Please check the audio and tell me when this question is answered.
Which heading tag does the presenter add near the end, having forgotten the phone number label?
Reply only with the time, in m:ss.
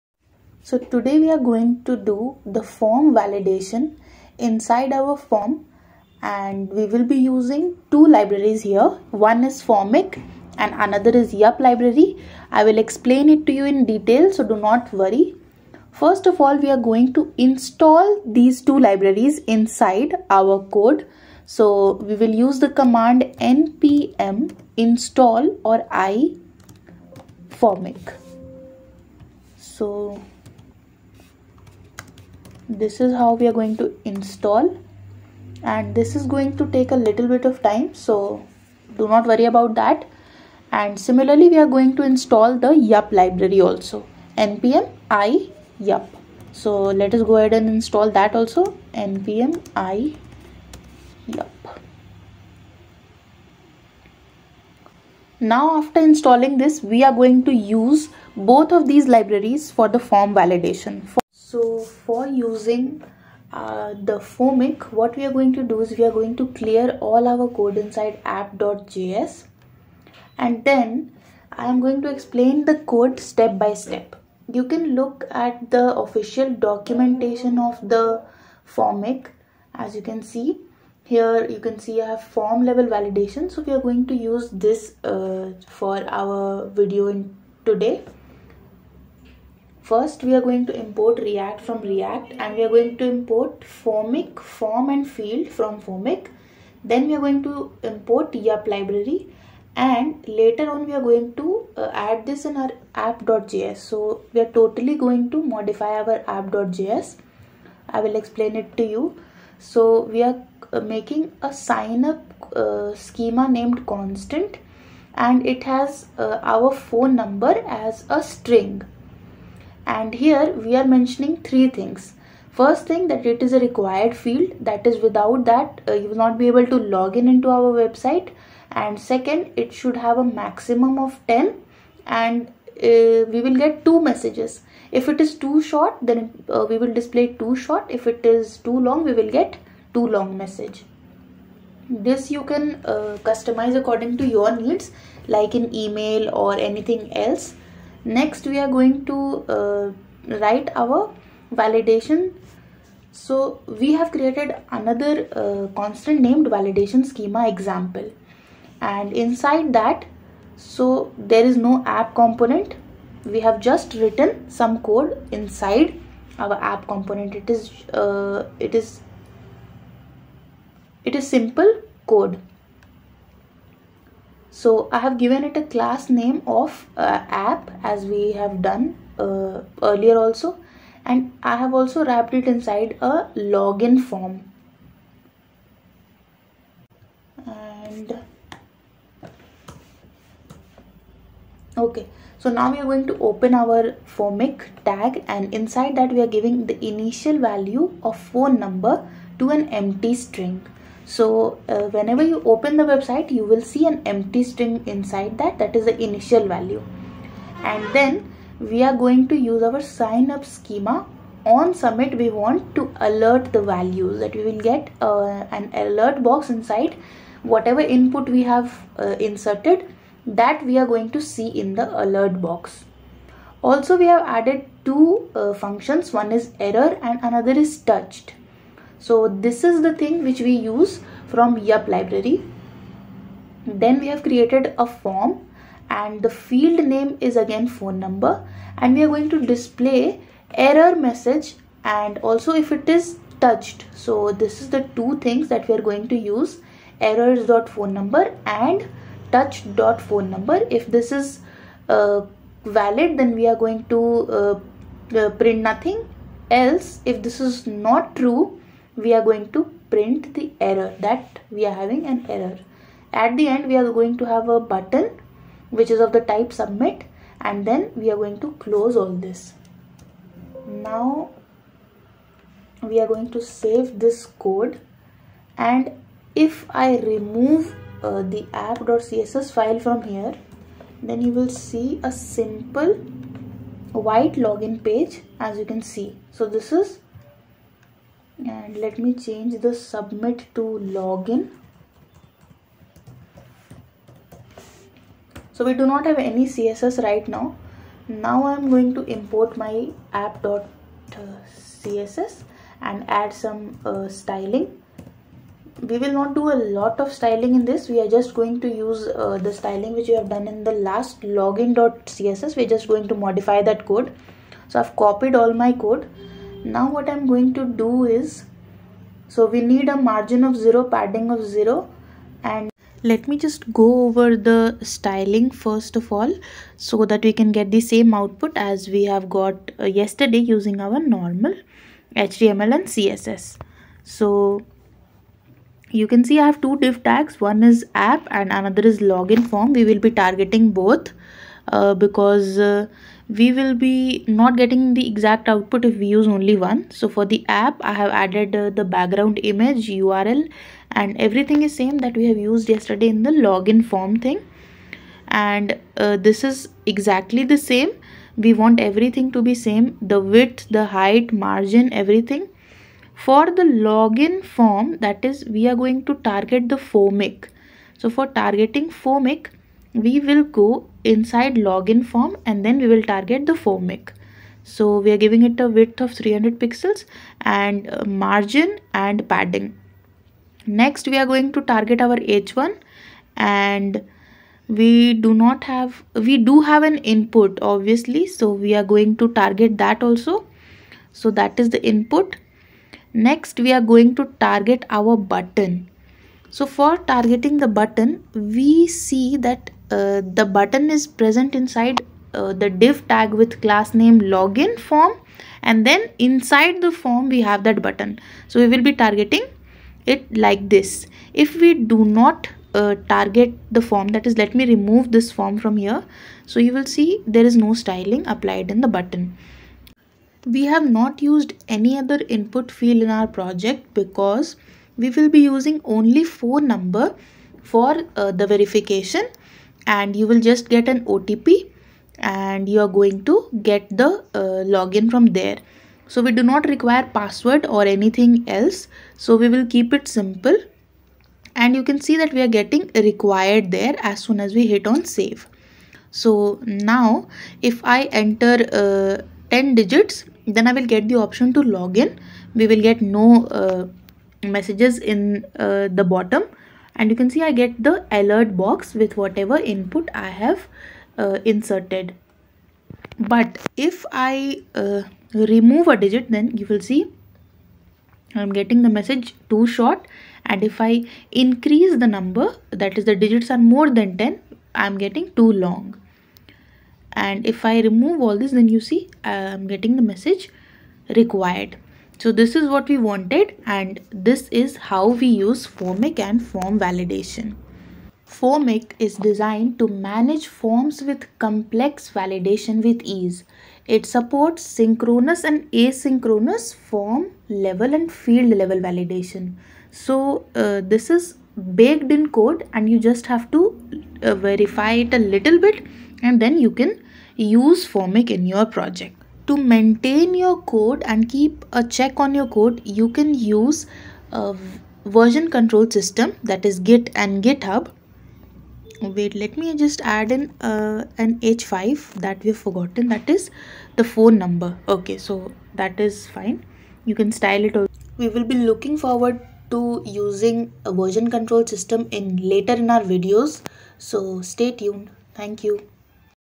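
8:41.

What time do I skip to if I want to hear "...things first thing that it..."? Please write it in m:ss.
2:01.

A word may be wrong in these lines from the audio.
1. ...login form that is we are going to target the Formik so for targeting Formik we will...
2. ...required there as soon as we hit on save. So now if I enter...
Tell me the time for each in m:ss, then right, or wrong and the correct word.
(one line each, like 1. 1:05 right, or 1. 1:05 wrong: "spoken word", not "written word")
1. 6:03 right
2. 7:22 right.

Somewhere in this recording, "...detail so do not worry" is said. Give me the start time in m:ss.
0:13.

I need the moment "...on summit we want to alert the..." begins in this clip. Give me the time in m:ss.
3:31.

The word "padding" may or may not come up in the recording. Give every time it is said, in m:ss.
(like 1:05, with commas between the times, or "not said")
5:20, 6:19.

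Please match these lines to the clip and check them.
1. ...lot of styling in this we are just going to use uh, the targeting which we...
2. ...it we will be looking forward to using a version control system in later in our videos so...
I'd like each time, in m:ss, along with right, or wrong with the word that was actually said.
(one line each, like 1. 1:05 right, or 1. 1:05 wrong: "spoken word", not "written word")
1. 5:06 wrong: "styling", not "targeting"
2. 8:47 right.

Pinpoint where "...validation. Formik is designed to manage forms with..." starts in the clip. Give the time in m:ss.
8:06.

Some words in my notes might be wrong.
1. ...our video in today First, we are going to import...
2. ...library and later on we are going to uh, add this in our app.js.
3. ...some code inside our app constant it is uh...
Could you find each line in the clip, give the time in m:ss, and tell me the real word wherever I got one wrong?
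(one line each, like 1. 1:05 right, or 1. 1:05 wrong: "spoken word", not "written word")
1. 1:26 right
2. 1:38 right
3. 2:44 wrong: "component", not "constant".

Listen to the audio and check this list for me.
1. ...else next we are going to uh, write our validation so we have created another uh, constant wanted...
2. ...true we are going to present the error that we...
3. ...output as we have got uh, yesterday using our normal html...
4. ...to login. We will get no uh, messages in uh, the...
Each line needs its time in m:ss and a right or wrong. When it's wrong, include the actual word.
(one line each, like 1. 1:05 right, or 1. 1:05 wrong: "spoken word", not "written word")
1. 2:27 wrong: "named", not "wanted"
2. 4:18 wrong: "print", not "present"
3. 5:28 right
4. 7:31 right.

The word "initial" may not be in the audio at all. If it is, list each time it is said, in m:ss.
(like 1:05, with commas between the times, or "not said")
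3:16, 3:26.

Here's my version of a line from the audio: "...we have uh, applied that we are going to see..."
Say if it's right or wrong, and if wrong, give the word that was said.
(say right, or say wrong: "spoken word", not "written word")
wrong: "inserted", not "applied".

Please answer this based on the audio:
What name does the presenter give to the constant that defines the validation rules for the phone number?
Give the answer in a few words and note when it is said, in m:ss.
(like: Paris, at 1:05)
sign up schema, at 1:51.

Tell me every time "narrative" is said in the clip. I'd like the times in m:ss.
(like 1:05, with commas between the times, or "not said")
not said.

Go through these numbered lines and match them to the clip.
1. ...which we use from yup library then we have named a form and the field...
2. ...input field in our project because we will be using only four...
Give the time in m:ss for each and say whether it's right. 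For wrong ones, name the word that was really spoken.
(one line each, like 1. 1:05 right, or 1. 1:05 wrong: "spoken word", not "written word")
1. 3:50 wrong: "created", not "named"
2. 7:02 right.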